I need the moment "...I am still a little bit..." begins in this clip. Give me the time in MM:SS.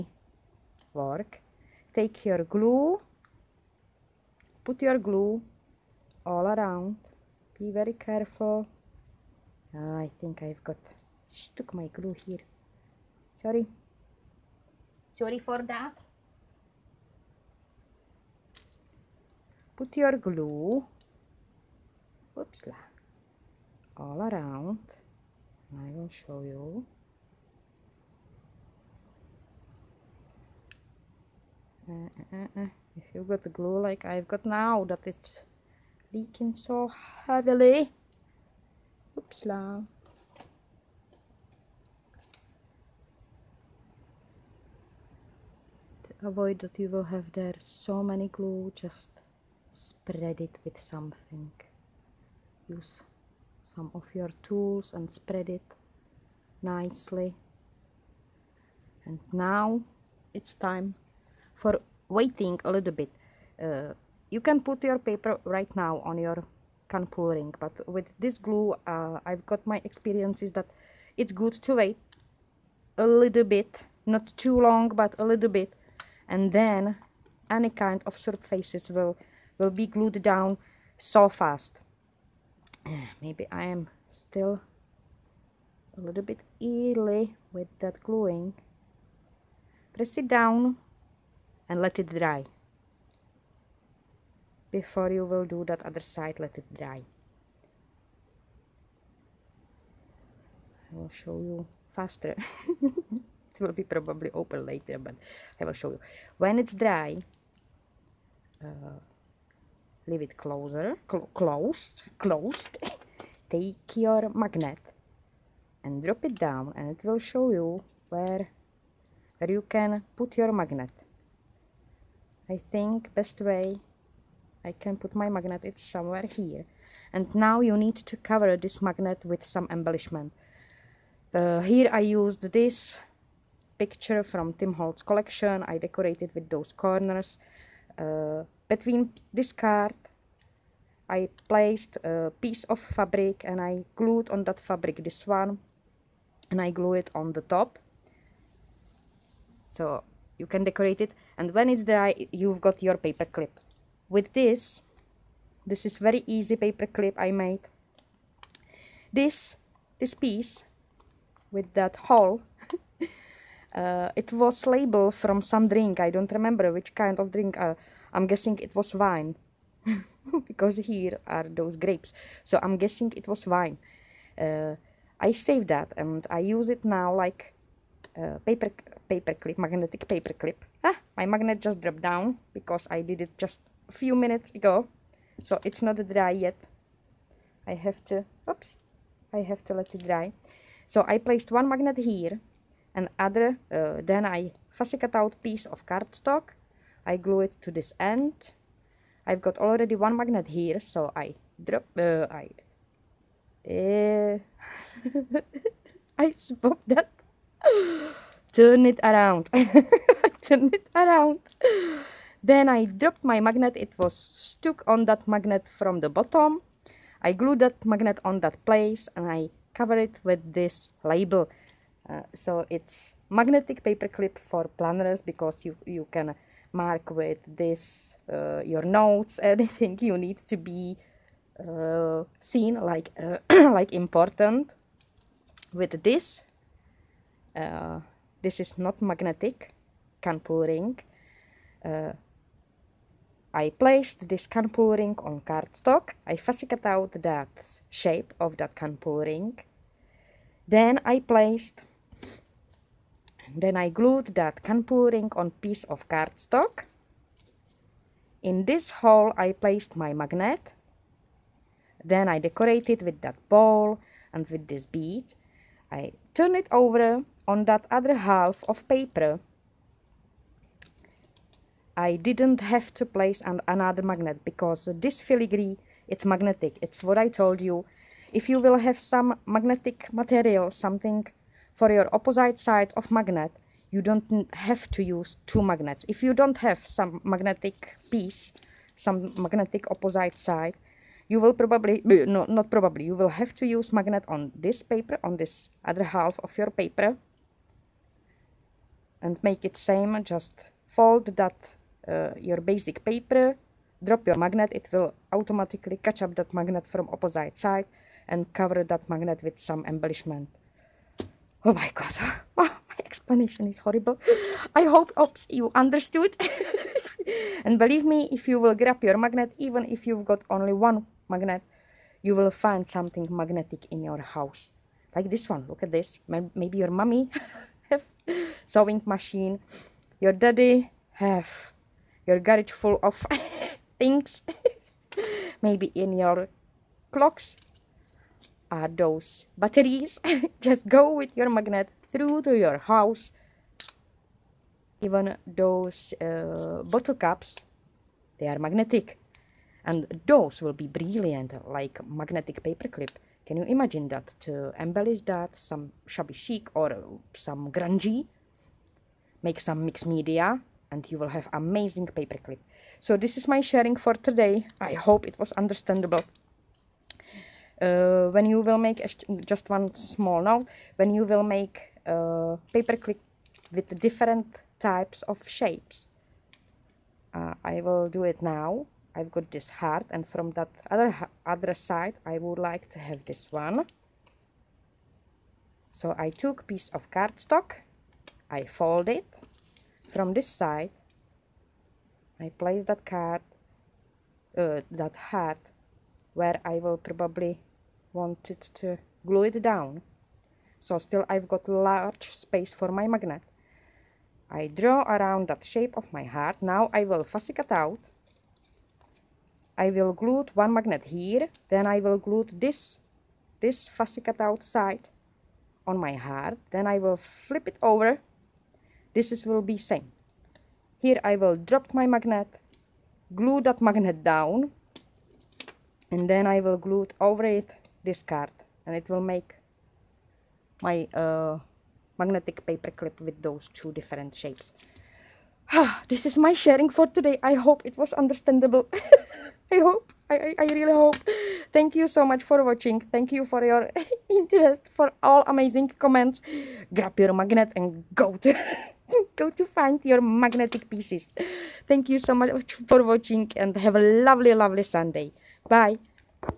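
01:23.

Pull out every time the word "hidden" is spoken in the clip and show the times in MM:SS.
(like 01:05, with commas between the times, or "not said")
not said.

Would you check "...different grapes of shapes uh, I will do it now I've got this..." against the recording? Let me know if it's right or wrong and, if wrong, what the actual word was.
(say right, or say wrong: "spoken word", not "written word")
wrong: "types", not "grapes".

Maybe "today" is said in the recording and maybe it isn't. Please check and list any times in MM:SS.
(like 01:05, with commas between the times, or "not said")
06:04, 07:17.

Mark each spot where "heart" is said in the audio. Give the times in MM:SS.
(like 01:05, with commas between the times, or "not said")
06:19, 06:35, 06:46, 06:56.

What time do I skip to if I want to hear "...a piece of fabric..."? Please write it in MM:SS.
02:21.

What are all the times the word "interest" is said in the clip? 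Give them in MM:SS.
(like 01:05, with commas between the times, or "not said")
07:24.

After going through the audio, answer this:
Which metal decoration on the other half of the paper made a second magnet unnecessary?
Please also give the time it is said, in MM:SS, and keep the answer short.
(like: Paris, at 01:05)
Filigree, at 04:35.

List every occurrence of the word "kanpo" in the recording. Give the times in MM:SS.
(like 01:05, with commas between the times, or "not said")
04:00, 04:04, 04:08.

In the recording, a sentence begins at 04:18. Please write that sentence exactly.
In this hole I placed my magnet.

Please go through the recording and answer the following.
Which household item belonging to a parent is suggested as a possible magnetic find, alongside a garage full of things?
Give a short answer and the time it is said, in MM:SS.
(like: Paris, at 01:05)
Sewing machine, at 05:28.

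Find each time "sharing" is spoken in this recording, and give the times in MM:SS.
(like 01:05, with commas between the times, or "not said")
06:03, 07:16.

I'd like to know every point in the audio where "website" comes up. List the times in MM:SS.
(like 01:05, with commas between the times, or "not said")
not said.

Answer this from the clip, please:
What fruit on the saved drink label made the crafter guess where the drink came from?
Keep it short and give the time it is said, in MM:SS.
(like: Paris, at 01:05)
Grapes, at 02:51.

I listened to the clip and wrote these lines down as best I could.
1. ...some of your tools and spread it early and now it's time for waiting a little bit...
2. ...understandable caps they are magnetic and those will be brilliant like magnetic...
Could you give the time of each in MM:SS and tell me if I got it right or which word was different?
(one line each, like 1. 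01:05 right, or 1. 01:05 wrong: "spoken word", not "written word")
1. 00:53 wrong: "nicely", not "early"
2. 05:46 wrong: "bottle", not "understandable".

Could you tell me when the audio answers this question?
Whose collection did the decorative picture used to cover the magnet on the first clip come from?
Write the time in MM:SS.
02:14.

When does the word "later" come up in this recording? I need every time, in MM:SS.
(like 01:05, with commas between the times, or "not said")
01:44.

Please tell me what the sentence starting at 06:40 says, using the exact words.
So still I've got large space for my magnet.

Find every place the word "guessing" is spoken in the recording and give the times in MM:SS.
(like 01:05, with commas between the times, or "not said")
02:48, 02:52.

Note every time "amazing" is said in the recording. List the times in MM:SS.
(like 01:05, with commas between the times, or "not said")
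06:01, 07:25.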